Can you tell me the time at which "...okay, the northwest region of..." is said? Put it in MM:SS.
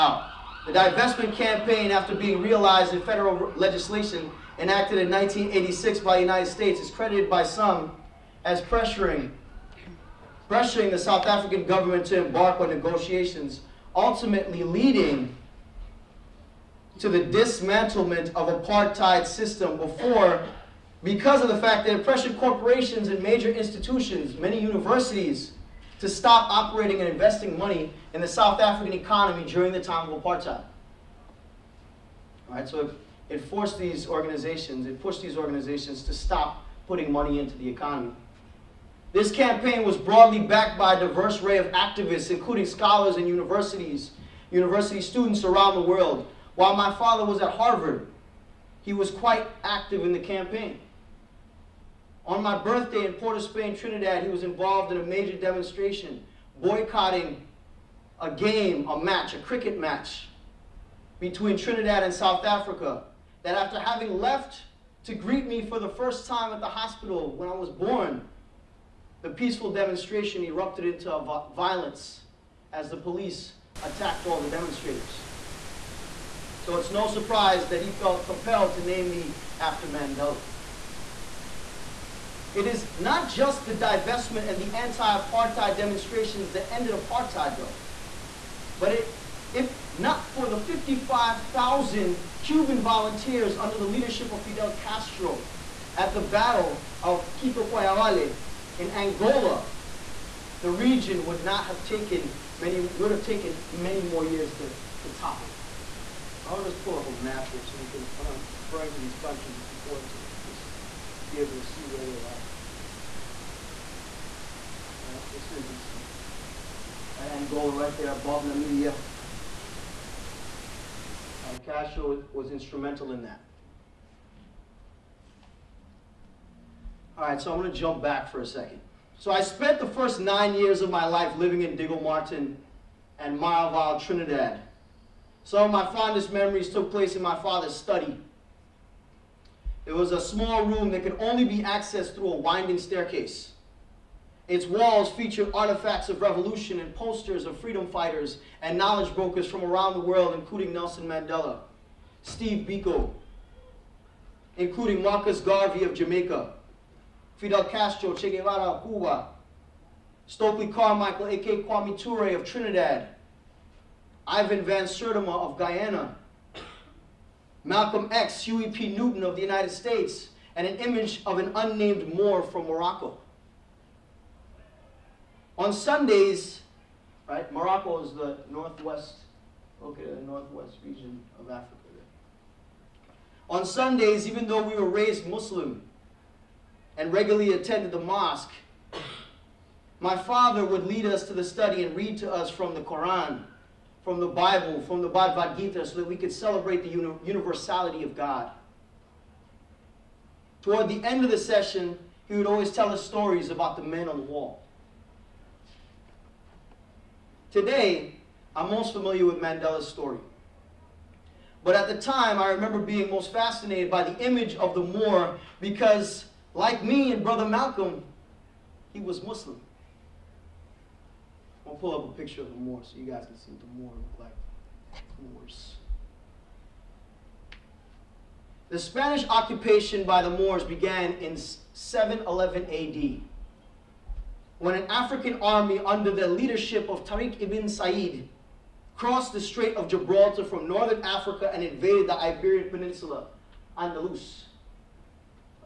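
02:59.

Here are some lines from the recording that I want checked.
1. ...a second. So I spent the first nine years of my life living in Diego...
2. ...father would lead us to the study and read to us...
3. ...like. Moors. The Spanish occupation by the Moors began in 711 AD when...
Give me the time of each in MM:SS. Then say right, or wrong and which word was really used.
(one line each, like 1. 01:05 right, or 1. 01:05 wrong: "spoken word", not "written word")
1. 02:08 right
2. 03:10 right
3. 03:44 right.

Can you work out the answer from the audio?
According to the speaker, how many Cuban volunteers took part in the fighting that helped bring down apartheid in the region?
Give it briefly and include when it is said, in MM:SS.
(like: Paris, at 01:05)
55,000, at 01:30.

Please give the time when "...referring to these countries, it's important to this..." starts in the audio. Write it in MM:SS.
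01:48.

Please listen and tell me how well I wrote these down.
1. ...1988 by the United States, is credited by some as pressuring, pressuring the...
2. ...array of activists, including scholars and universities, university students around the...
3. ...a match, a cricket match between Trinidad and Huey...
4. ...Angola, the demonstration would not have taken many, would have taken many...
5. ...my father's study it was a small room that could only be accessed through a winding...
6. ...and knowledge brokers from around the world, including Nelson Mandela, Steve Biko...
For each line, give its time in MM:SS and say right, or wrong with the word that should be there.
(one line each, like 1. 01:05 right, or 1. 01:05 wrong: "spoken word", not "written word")
1. 00:05 wrong: "1986", not "1988"
2. 00:41 right
3. 00:58 wrong: "South", not "Huey"
4. 01:38 wrong: "region", not "demonstration"
5. 02:17 right
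6. 02:28 right.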